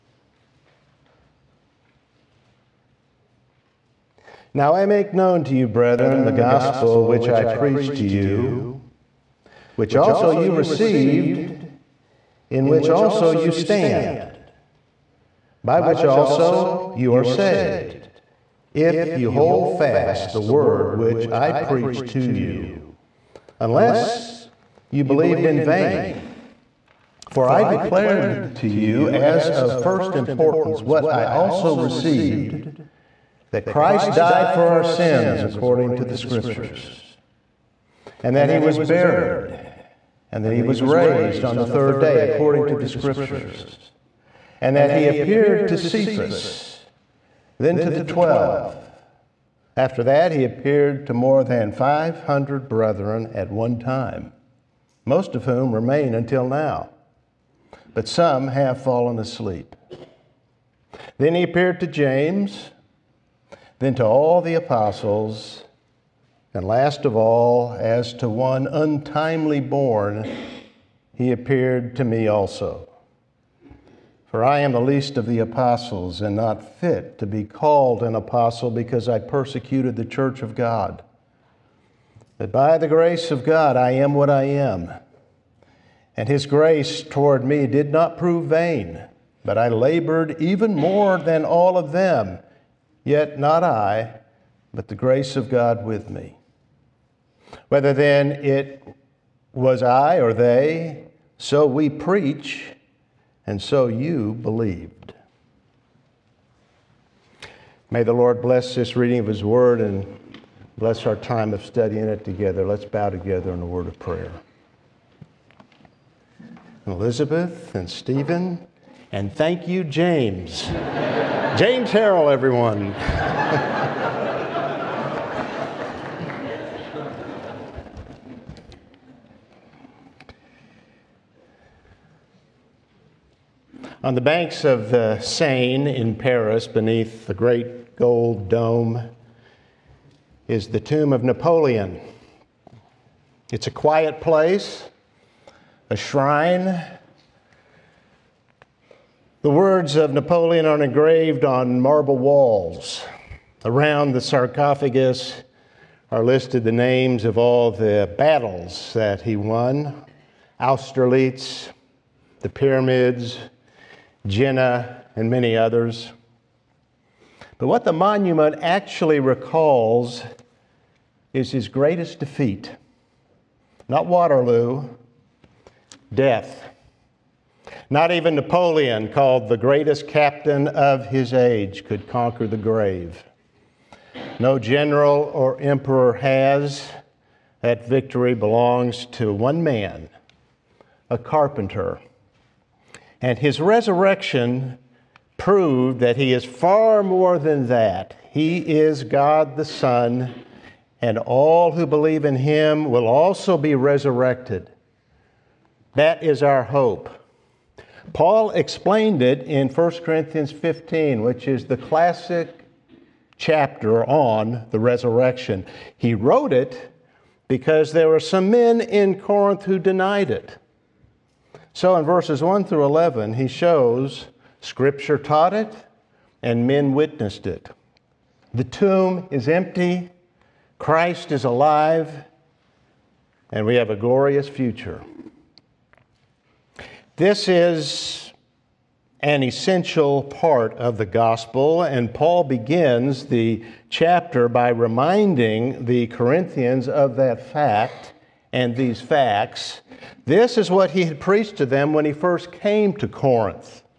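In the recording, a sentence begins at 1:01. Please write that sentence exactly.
Then he appeared to James, then to all the apostles.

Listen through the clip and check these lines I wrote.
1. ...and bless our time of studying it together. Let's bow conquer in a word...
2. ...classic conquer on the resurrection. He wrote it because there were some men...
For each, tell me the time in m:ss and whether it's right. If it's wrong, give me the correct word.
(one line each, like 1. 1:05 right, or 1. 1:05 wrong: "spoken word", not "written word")
1. 1:49 wrong: "together", not "conquer"
2. 3:31 wrong: "chapter", not "conquer".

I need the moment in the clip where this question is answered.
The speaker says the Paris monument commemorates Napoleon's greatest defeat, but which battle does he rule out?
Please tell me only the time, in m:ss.
2:54.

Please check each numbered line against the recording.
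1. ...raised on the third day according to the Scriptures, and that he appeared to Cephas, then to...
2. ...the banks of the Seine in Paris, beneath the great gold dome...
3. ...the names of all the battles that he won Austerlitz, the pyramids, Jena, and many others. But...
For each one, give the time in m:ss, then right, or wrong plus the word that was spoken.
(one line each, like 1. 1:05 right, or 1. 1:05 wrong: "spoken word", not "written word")
1. 0:40 right
2. 2:14 right
3. 2:36 right.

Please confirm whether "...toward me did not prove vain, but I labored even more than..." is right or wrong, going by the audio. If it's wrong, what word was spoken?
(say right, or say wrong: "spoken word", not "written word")
right.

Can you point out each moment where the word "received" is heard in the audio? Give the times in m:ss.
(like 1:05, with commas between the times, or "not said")
0:10, 0:31.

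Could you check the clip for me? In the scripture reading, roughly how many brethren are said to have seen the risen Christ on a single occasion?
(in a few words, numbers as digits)
more than 500.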